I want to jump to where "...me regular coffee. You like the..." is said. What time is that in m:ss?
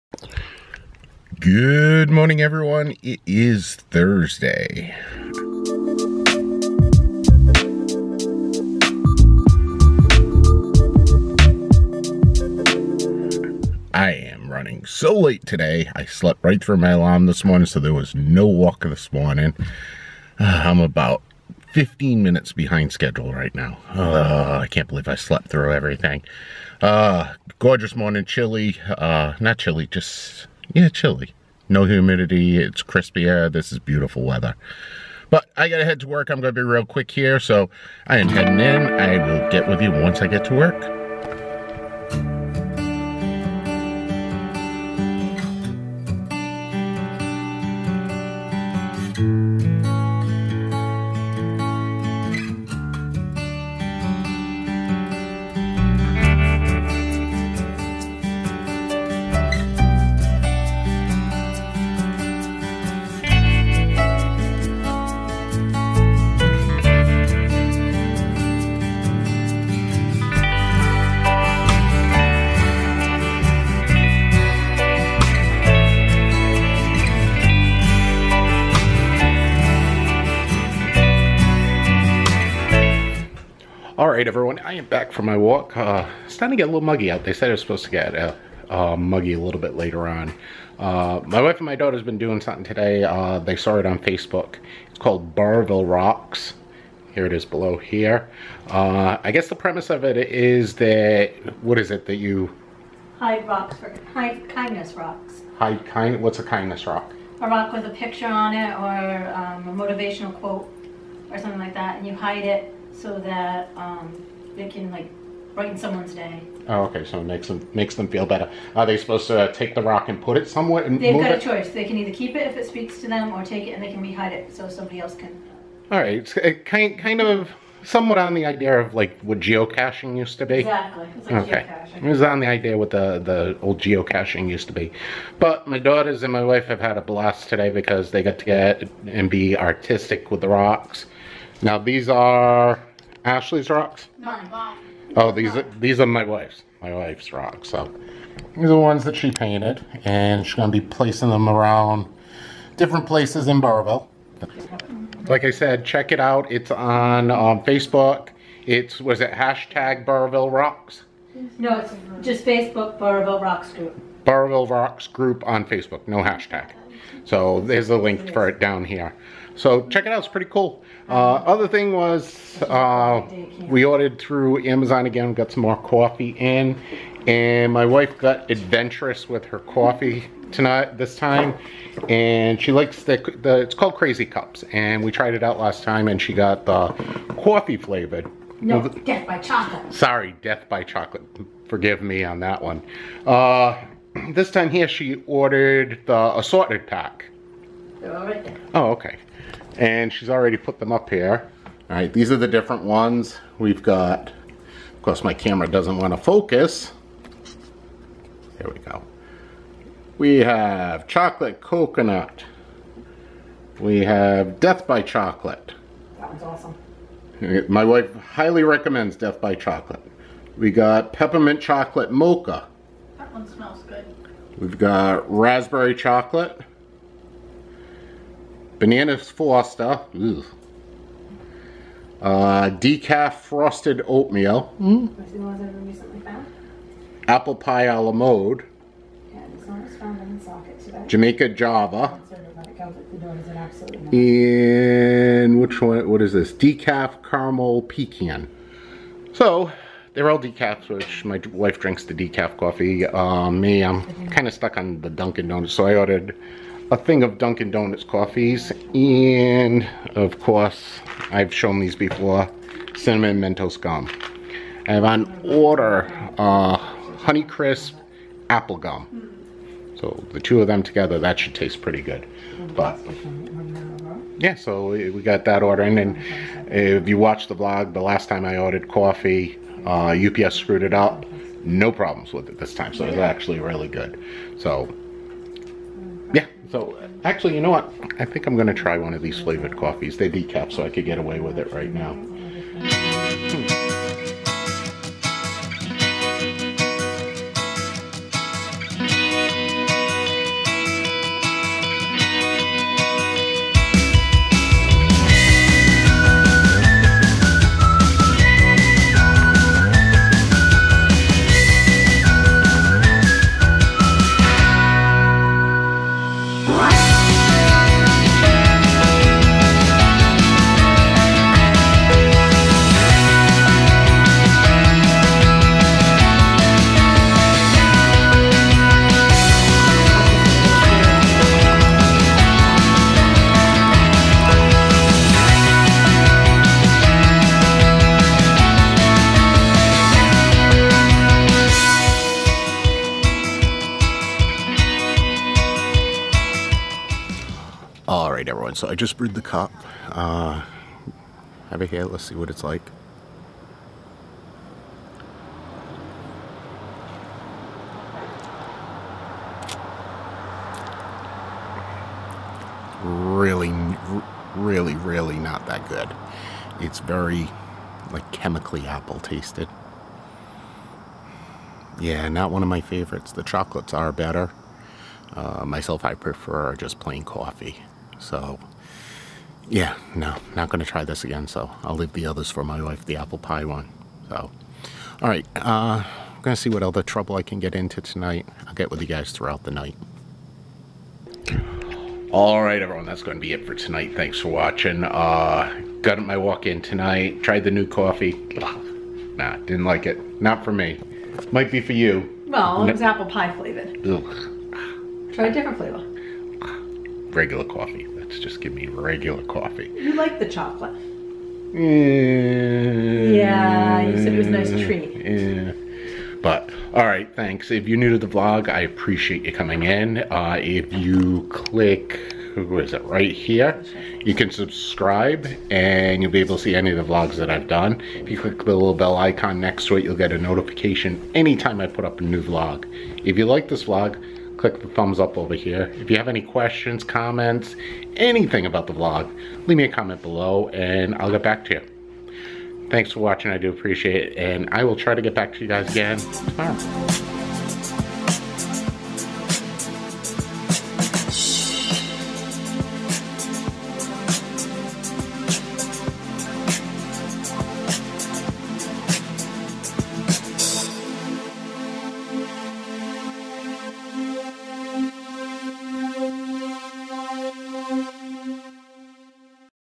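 6:48.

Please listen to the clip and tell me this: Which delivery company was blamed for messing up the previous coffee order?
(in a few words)
UPS.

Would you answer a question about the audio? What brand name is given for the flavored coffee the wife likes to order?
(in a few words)
Crazy Cups.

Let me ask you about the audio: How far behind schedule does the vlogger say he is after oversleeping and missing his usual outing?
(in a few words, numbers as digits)
15 minutes.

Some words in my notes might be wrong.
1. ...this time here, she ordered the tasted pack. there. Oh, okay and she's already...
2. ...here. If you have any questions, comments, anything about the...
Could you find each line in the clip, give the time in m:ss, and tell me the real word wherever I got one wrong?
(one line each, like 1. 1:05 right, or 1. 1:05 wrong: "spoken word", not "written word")
1. 3:14 wrong: "assorted", not "tasted"
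2. 7:15 right.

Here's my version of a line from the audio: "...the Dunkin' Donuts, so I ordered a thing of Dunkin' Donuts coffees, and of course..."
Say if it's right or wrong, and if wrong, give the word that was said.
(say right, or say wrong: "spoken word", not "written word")
right.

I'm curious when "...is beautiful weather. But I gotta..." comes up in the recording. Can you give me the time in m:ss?
0:33.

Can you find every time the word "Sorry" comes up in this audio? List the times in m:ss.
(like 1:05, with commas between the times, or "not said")
3:09.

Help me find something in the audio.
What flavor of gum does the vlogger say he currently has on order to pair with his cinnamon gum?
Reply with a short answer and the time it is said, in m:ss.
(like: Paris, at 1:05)
Honeycrisp apple, at 4:27.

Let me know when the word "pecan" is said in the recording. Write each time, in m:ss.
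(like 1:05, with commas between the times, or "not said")
4:07.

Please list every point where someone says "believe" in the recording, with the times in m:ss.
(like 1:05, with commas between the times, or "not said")
0:24.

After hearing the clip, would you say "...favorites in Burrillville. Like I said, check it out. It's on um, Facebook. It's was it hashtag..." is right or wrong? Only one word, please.
wrong.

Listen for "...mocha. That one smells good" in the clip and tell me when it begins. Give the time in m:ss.
3:42.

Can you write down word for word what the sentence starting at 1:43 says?
Hide rocks, for, hide kindness rocks.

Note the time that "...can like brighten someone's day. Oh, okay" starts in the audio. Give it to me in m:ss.
1:54.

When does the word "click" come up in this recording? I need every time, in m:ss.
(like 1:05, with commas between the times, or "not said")
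7:01, 7:08, 7:14.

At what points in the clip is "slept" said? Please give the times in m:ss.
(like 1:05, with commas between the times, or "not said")
0:16, 0:25.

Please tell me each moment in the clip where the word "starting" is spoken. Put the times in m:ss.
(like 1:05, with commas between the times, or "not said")
1:26.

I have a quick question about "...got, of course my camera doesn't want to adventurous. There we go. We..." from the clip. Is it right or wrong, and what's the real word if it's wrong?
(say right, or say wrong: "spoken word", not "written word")
wrong: "focus", not "adventurous".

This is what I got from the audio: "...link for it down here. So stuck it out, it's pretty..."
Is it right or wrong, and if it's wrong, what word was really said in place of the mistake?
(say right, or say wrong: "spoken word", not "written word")
wrong: "check", not "stuck".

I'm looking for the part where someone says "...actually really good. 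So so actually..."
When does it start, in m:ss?
4:43.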